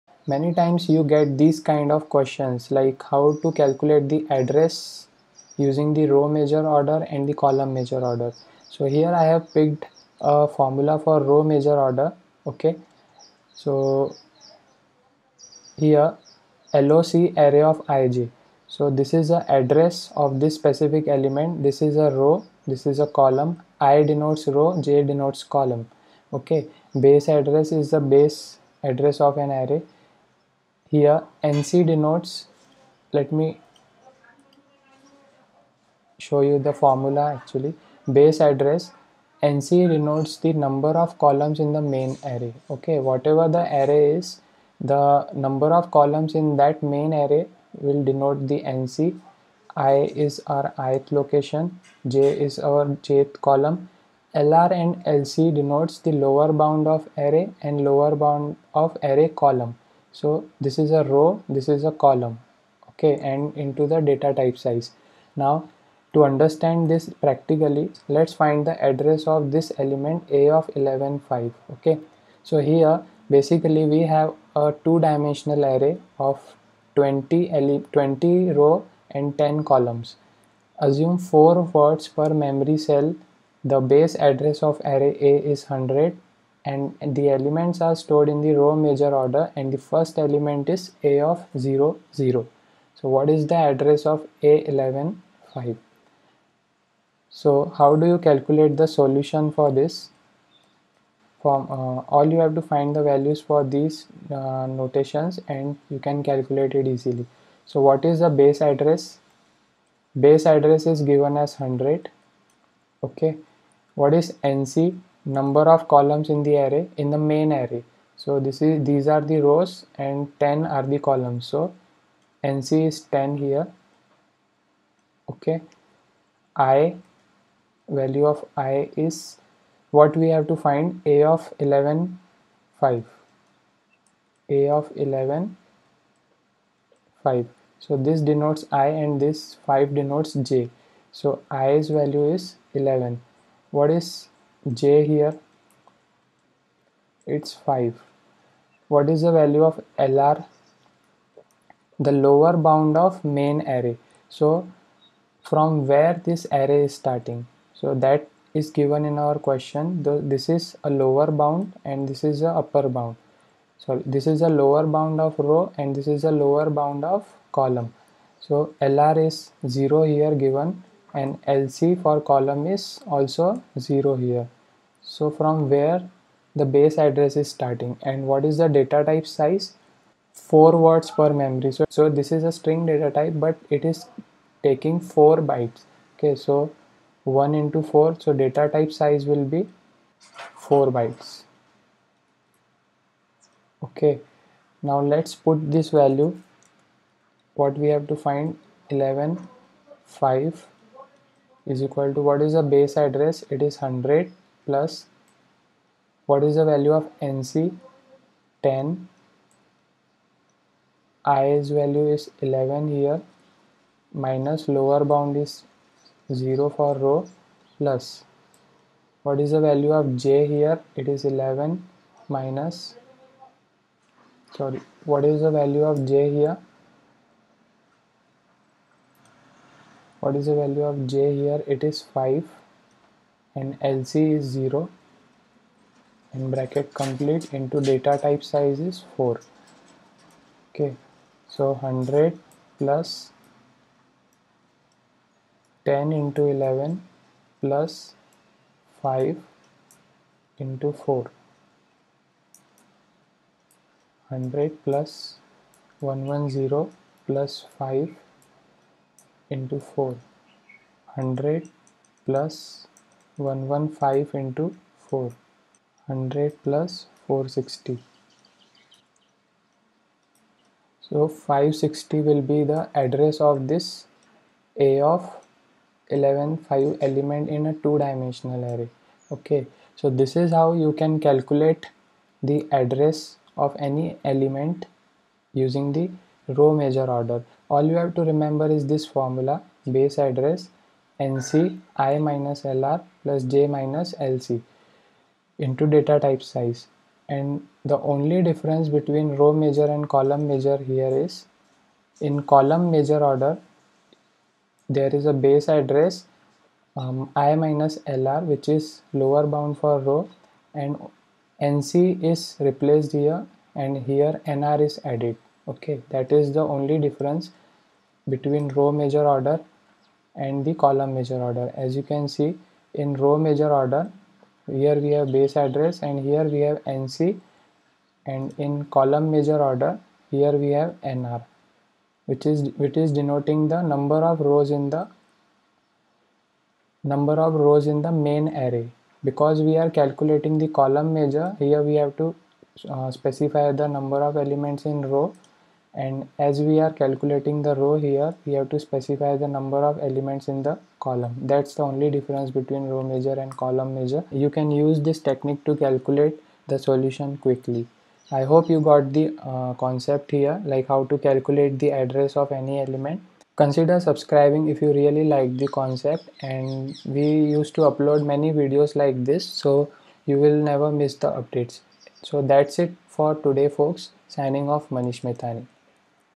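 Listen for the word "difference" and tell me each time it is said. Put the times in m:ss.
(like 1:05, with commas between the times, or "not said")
4:58, 5:17, 5:52.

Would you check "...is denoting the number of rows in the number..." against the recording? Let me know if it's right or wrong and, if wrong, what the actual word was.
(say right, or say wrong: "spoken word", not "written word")
right.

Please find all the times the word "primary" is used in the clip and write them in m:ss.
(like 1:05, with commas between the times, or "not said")
not said.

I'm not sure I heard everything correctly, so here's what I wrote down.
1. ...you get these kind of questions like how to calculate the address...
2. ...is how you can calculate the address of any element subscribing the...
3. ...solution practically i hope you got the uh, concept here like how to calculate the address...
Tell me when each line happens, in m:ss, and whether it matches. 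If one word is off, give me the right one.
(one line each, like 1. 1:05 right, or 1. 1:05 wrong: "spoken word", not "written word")
1. 0:00 right
2. 4:40 wrong: "using", not "subscribing"
3. 5:56 wrong: "quickly", not "practically".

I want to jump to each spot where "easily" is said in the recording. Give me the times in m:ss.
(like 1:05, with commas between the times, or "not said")
1:46.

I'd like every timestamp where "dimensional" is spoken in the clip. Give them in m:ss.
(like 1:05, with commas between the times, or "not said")
1:14, 4:38.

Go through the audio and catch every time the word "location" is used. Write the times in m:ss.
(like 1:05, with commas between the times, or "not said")
0:51.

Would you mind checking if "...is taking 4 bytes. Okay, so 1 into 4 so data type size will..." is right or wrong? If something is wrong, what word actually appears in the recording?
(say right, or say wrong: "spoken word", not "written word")
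right.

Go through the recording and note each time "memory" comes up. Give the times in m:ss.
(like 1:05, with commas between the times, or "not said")
1:22, 3:01.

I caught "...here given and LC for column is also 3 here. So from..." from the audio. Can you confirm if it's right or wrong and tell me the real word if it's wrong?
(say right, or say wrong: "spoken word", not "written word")
wrong: "0", not "3".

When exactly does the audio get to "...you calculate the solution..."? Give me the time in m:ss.
1:38.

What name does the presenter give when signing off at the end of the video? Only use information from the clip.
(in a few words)
Manish Methani.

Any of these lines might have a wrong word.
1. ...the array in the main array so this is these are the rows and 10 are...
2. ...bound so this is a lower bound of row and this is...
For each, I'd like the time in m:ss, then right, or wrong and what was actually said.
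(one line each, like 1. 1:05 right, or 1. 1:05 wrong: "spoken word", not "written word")
1. 1:56 right
2. 2:42 right.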